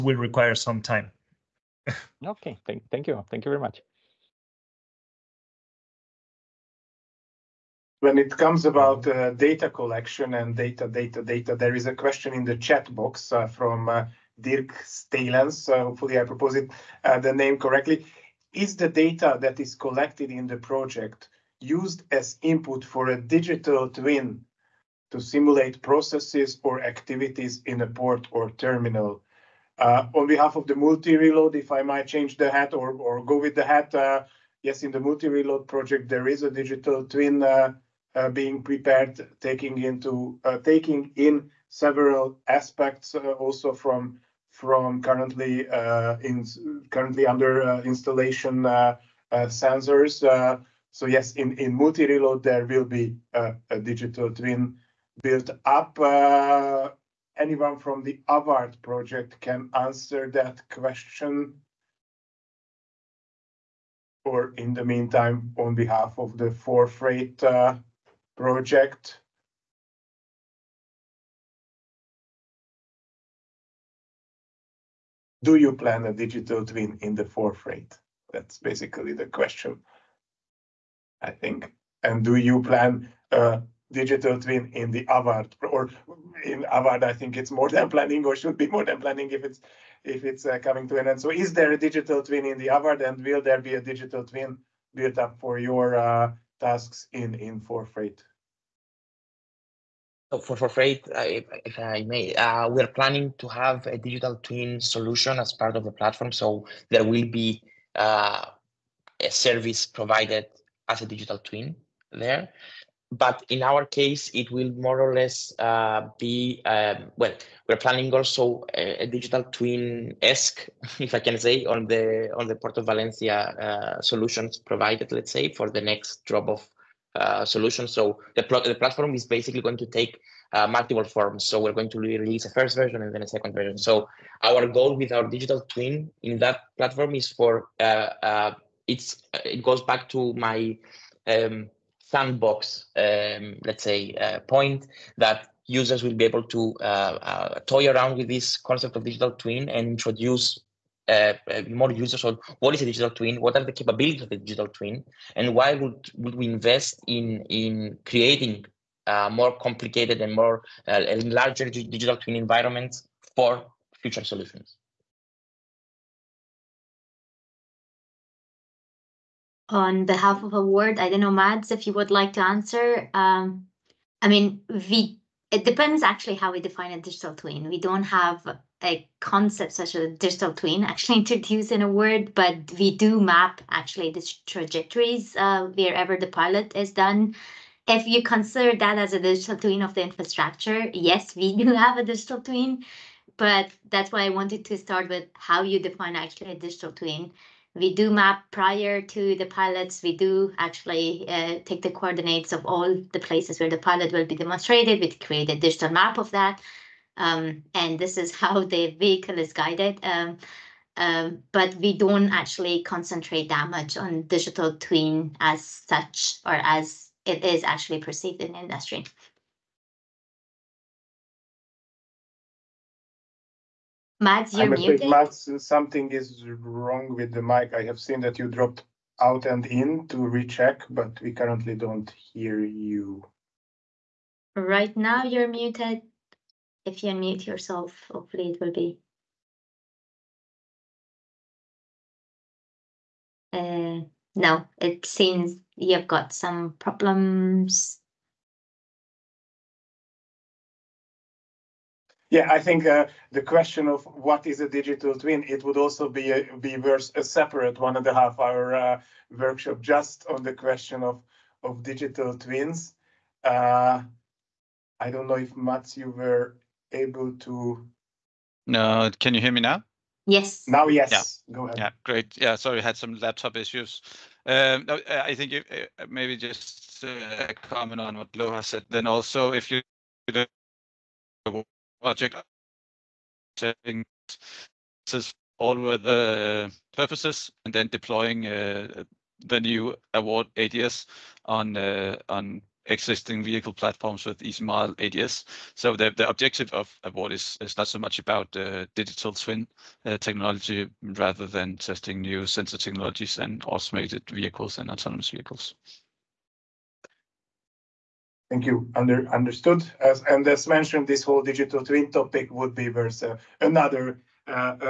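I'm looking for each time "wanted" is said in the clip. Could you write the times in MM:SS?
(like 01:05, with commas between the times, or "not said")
03:14.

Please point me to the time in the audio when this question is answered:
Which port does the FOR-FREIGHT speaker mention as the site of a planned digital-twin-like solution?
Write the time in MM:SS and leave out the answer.
02:02.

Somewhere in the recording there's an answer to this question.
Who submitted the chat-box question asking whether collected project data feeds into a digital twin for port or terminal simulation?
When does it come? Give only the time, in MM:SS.
00:14.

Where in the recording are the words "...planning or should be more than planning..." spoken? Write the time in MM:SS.
01:27.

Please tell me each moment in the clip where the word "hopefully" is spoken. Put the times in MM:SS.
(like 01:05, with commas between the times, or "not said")
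00:15, 03:58.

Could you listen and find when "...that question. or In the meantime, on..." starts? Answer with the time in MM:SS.
01:00.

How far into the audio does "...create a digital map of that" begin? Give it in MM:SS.
03:25.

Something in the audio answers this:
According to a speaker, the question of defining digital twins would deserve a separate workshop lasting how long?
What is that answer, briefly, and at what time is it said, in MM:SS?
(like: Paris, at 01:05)
one and a half hour, at 04:17.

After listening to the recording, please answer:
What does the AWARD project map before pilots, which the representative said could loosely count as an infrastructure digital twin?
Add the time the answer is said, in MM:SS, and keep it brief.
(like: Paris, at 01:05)
trajectories, at 03:04.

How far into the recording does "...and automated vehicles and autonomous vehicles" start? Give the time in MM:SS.
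05:03.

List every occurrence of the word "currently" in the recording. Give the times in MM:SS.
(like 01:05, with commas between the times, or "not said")
00:45, 03:51.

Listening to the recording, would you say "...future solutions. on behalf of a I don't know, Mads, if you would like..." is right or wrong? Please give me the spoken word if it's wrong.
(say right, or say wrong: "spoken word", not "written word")
right.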